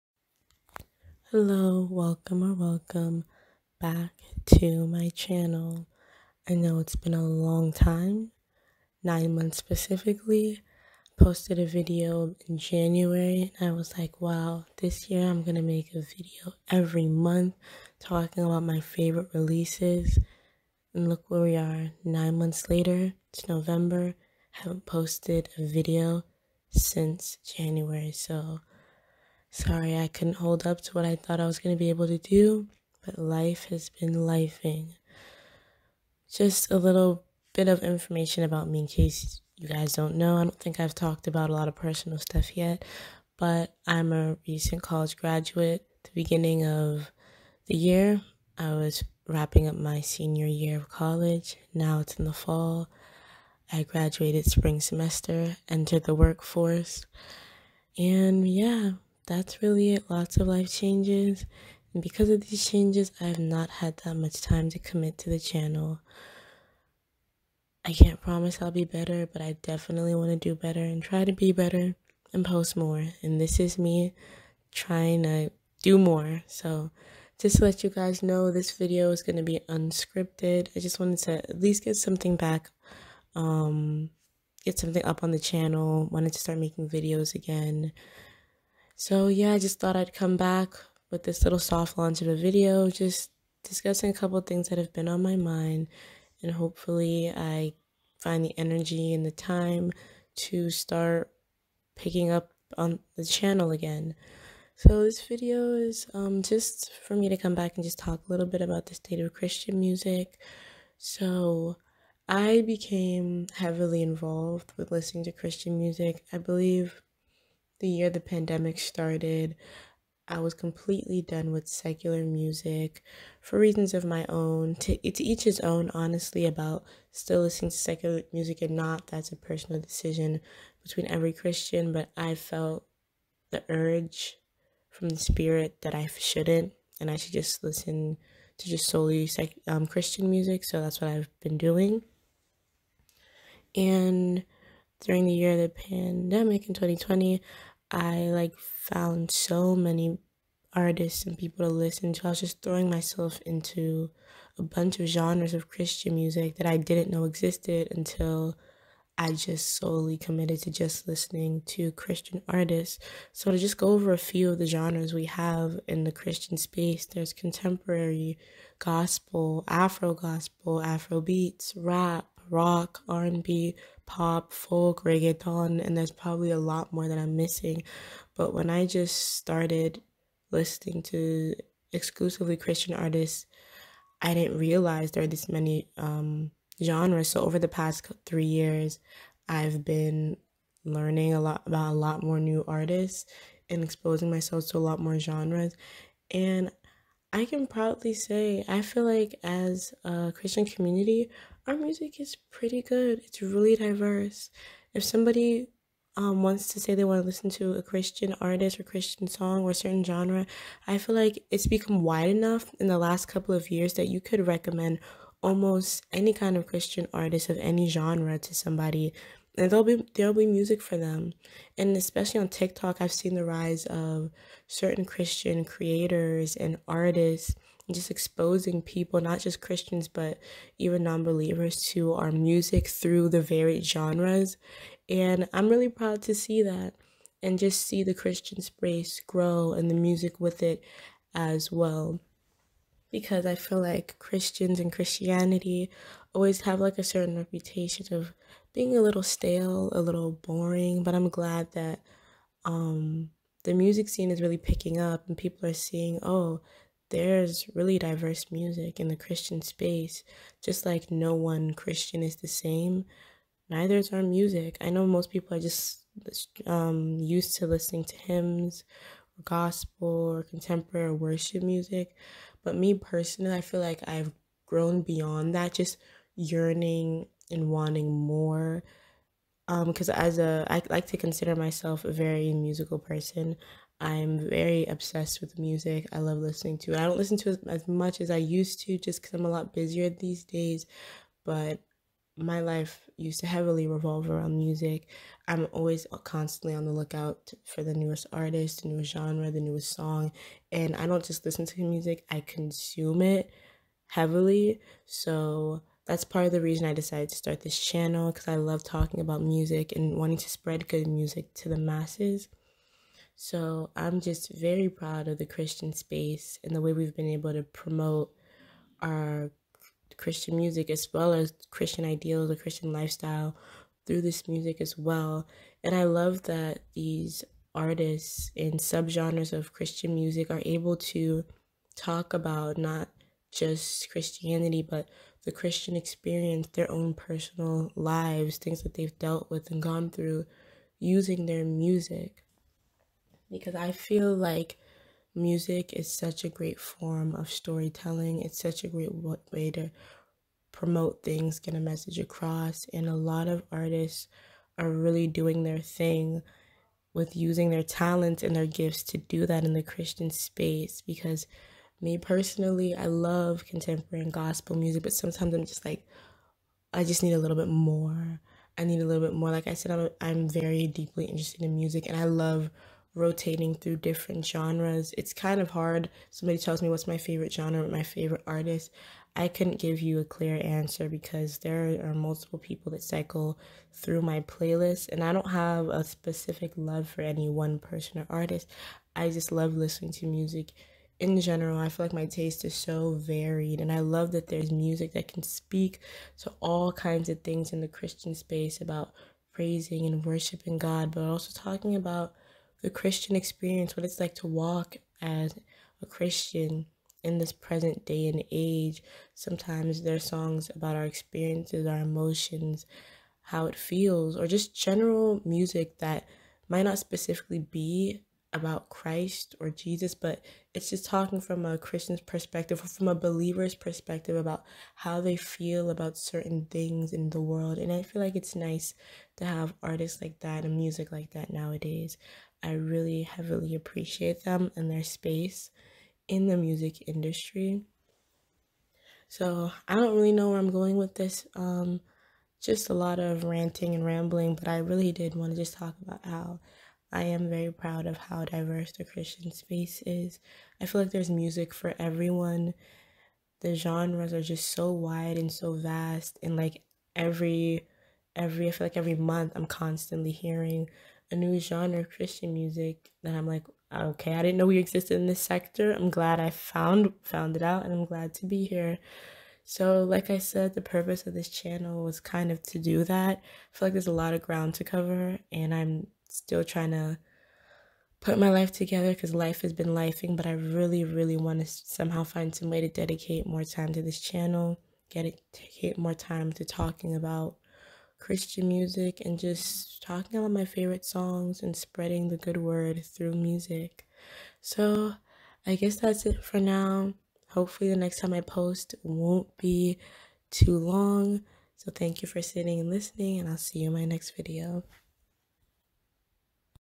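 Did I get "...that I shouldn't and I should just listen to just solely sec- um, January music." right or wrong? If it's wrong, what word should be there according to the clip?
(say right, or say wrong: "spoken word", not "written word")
wrong: "Christian", not "January".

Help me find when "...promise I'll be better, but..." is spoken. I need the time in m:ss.
1:08.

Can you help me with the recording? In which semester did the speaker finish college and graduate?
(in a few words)
Spring semester.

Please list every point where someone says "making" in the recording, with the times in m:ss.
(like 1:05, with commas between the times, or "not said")
1:26.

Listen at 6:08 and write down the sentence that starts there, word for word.
I need a little bit more.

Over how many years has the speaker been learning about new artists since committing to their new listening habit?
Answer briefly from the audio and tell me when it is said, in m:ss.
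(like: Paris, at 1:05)
3 years, at 3:08.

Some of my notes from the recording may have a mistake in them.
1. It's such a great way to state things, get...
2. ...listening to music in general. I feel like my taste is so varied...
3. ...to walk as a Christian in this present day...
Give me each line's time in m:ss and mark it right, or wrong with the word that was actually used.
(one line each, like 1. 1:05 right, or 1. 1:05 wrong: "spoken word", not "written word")
1. 5:48 wrong: "promote", not "state"
2. 6:29 right
3. 6:44 right.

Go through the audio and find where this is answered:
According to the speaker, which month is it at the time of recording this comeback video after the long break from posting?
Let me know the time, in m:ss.
0:23.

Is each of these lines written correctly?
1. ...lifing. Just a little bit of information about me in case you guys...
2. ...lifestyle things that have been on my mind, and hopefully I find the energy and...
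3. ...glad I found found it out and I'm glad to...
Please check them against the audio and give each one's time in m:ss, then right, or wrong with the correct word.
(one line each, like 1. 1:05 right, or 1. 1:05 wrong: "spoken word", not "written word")
1. 0:34 right
2. 1:34 wrong: "couple", not "lifestyle"
3. 7:46 right.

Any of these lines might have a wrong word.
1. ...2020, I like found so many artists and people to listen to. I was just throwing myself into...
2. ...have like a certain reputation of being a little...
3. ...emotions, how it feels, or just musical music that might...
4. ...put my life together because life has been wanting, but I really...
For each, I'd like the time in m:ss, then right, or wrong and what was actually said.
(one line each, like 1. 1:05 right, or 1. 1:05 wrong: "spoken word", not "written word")
1. 2:26 right
2. 4:06 right
3. 6:51 wrong: "general", not "musical"
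4. 7:58 wrong: "lifing", not "wanting".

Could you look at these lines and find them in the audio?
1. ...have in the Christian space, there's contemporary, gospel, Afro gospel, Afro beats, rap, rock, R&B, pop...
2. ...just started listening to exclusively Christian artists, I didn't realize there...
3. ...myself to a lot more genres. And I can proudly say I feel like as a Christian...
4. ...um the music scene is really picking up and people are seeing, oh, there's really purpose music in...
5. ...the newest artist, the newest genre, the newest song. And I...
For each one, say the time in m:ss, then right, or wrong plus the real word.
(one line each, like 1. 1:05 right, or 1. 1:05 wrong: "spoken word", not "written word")
1. 2:45 right
2. 2:58 right
3. 3:14 right
4. 4:12 wrong: "diverse", not "purpose"
5. 4:57 right.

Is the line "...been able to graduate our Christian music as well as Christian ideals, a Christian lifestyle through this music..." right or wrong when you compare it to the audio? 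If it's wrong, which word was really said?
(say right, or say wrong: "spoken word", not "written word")
wrong: "promote", not "graduate".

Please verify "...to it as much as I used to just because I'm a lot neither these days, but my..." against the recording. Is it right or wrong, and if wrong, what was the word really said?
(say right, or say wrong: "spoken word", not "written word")
wrong: "busier", not "neither".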